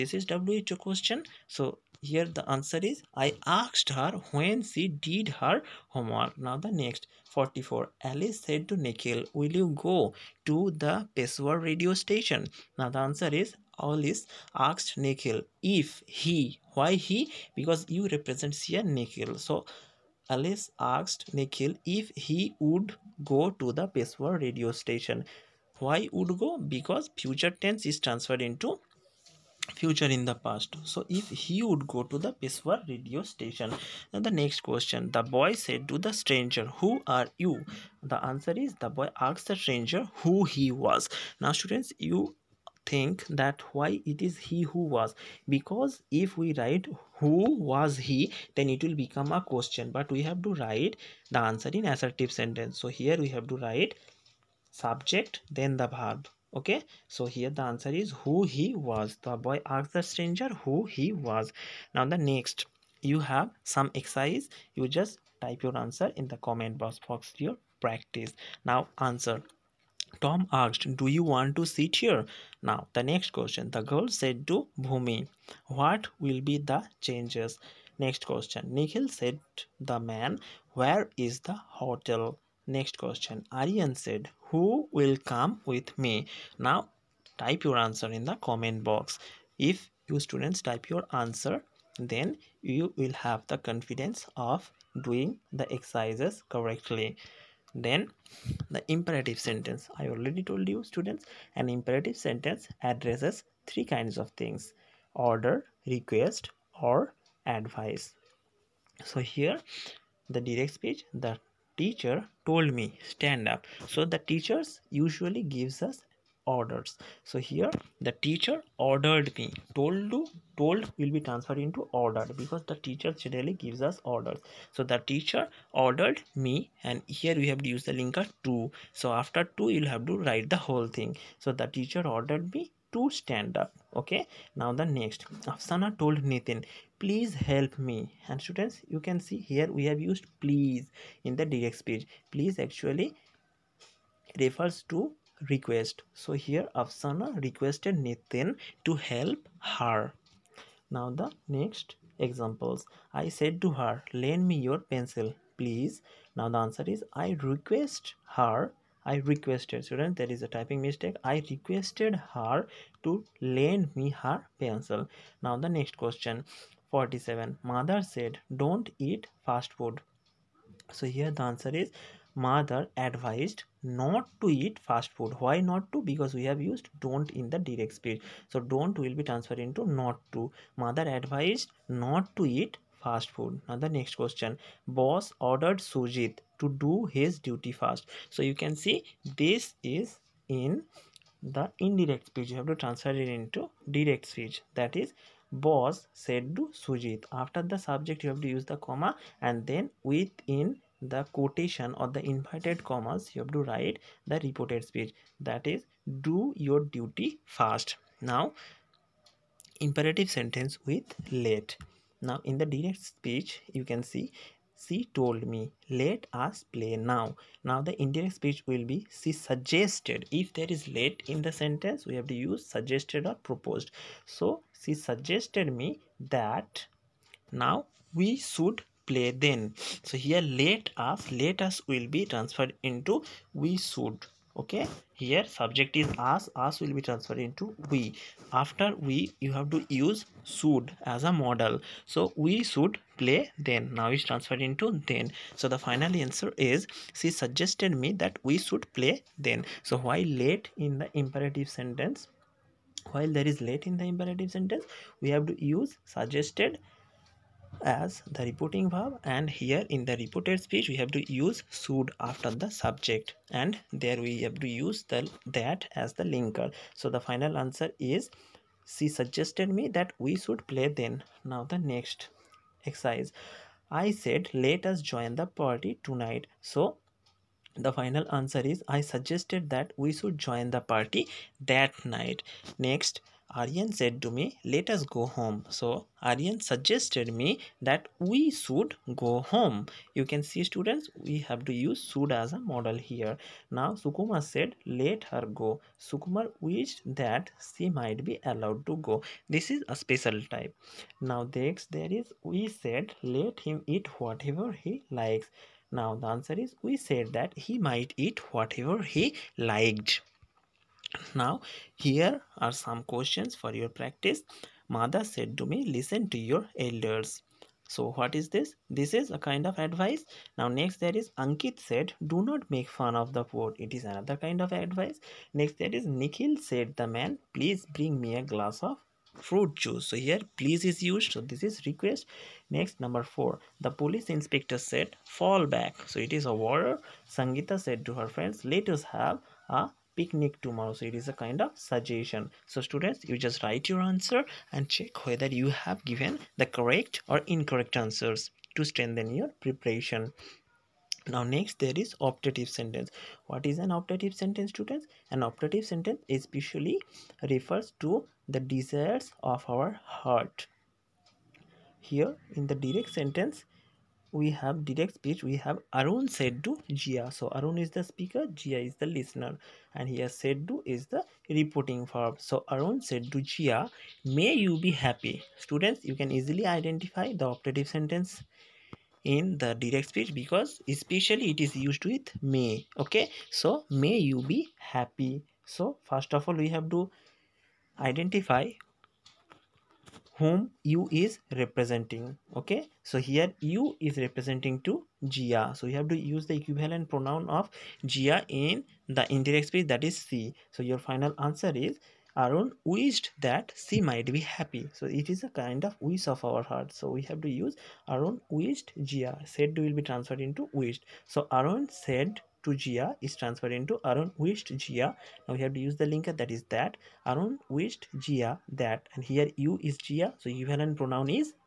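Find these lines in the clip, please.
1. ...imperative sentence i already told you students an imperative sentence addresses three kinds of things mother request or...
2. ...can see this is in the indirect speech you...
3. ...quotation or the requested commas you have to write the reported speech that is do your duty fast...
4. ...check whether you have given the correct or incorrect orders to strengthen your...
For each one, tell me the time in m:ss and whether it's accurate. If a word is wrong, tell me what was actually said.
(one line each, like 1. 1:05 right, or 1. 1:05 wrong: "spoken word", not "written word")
1. 1:38 wrong: "order", not "mother"
2. 3:08 right
3. 3:21 wrong: "inverted", not "requested"
4. 5:44 wrong: "answers", not "orders".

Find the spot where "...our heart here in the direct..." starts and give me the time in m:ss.
5:59.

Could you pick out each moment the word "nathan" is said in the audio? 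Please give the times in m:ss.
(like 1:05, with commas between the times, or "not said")
2:16, 2:28.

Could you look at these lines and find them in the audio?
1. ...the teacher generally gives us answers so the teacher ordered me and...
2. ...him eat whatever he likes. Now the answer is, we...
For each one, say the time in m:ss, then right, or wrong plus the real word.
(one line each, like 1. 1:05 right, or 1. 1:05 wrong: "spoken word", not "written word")
1. 2:02 wrong: "orders", not "answers"
2. 5:03 right.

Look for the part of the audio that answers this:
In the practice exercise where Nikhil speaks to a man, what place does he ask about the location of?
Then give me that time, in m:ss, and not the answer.
1:21.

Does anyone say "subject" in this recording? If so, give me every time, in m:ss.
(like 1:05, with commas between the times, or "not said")
0:54, 3:17, 3:55, 4:22.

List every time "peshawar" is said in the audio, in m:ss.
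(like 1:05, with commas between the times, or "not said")
0:11, 0:23, 0:32.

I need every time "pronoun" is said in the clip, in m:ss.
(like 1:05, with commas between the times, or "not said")
6:37, 7:00.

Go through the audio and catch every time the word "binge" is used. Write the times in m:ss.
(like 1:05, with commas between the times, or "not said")
not said.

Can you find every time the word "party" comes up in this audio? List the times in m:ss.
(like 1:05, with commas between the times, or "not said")
4:35, 4:40.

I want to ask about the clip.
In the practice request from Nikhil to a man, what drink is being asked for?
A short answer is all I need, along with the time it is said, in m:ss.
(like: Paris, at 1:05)
a glass of fruit juice, at 5:28.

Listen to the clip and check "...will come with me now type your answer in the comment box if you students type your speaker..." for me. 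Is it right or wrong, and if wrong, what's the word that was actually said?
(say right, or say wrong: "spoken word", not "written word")
wrong: "answer", not "speaker".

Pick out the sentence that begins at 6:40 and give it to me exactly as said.
so your final answer is Arun wished that she might be happy.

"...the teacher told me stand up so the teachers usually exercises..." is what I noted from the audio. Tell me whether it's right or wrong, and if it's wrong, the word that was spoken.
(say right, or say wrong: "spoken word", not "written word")
wrong: "gives", not "exercises".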